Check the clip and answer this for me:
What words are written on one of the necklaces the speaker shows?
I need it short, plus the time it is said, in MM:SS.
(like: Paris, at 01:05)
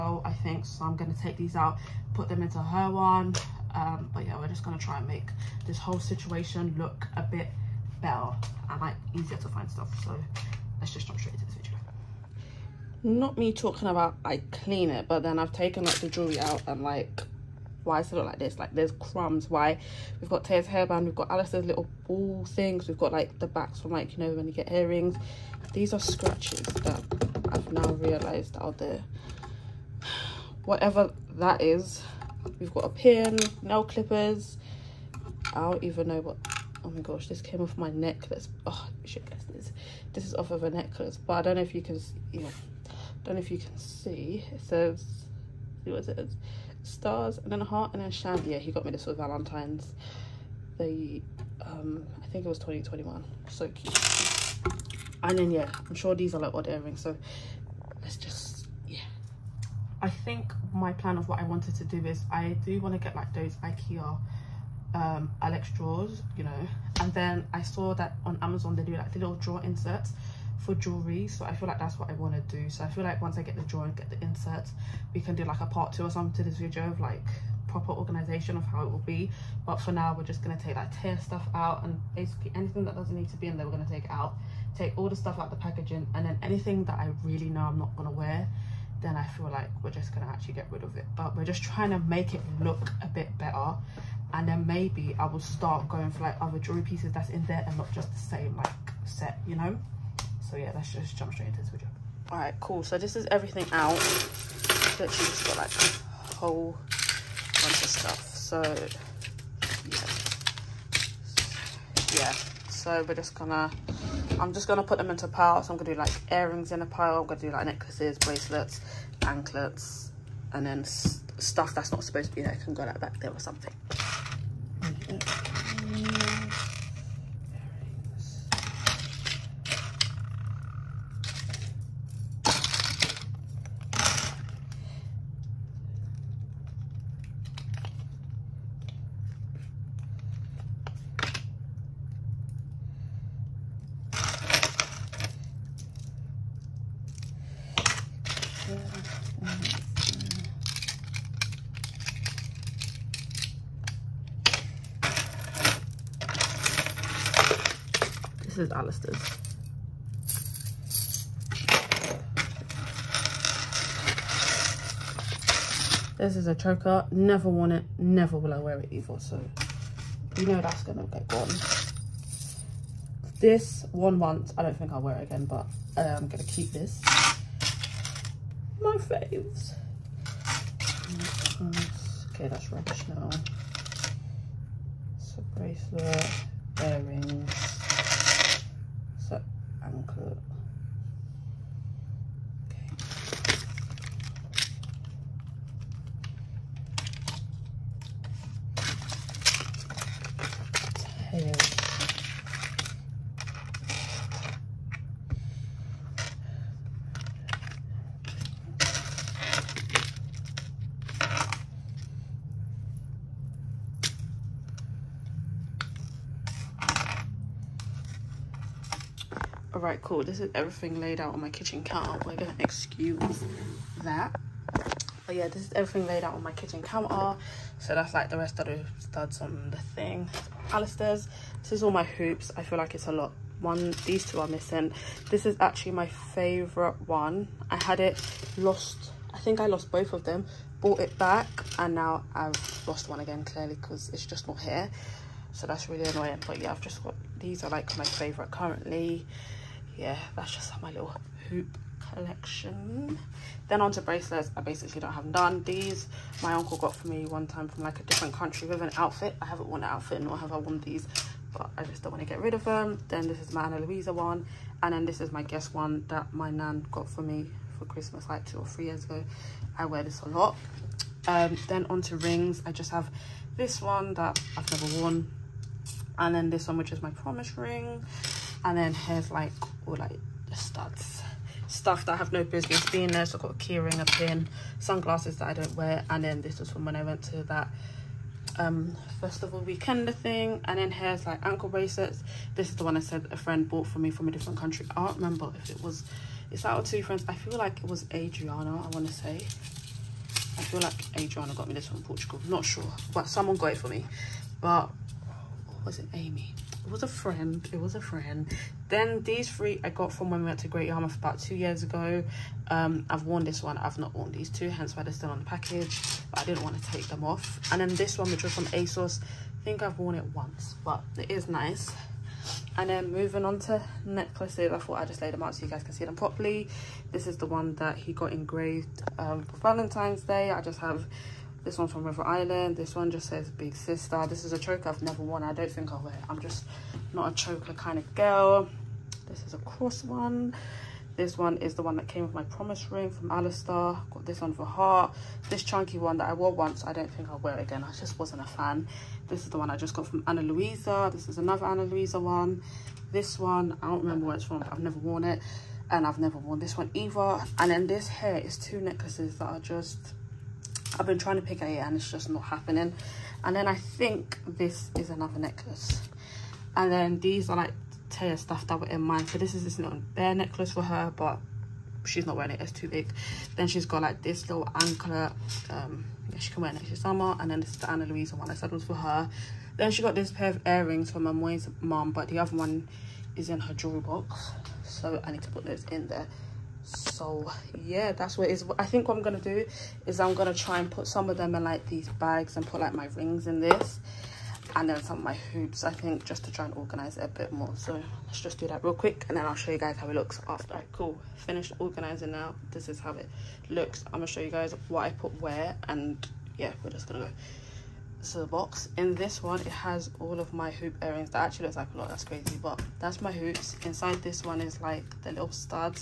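Big Sister, at 05:33.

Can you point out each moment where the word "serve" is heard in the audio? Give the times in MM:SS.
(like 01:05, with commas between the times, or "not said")
not said.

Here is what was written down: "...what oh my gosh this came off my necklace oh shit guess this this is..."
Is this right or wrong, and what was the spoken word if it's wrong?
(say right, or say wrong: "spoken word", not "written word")
right.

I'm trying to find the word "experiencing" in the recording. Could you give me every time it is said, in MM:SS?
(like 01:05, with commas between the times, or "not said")
not said.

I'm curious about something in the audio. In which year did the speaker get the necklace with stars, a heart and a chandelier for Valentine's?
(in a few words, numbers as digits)
2021.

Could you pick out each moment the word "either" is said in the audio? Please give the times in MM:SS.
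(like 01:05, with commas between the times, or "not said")
02:48, 05:56.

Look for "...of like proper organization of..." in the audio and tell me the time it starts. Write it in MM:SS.
01:16.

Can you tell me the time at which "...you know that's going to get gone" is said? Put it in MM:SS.
02:50.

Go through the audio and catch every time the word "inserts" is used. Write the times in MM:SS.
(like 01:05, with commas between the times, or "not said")
01:09, 01:14.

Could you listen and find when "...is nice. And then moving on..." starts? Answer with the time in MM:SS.
05:21.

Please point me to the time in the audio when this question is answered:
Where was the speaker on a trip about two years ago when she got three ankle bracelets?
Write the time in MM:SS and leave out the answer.
05:10.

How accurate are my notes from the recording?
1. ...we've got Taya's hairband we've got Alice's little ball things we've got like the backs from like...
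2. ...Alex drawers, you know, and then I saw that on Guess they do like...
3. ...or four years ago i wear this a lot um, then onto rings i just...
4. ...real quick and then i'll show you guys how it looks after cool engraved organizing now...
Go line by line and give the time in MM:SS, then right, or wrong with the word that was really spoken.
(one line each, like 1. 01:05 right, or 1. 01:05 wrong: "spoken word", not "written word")
1. 00:20 right
2. 01:05 wrong: "Amazon", not "Guess"
3. 04:28 wrong: "three", not "four"
4. 06:38 wrong: "finished", not "engraved".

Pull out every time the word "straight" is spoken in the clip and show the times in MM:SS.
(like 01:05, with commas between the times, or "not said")
00:11, 01:41.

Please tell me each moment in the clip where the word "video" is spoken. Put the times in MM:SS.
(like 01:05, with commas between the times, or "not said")
00:11, 01:16, 01:41.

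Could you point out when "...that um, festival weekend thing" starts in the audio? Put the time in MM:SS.
04:47.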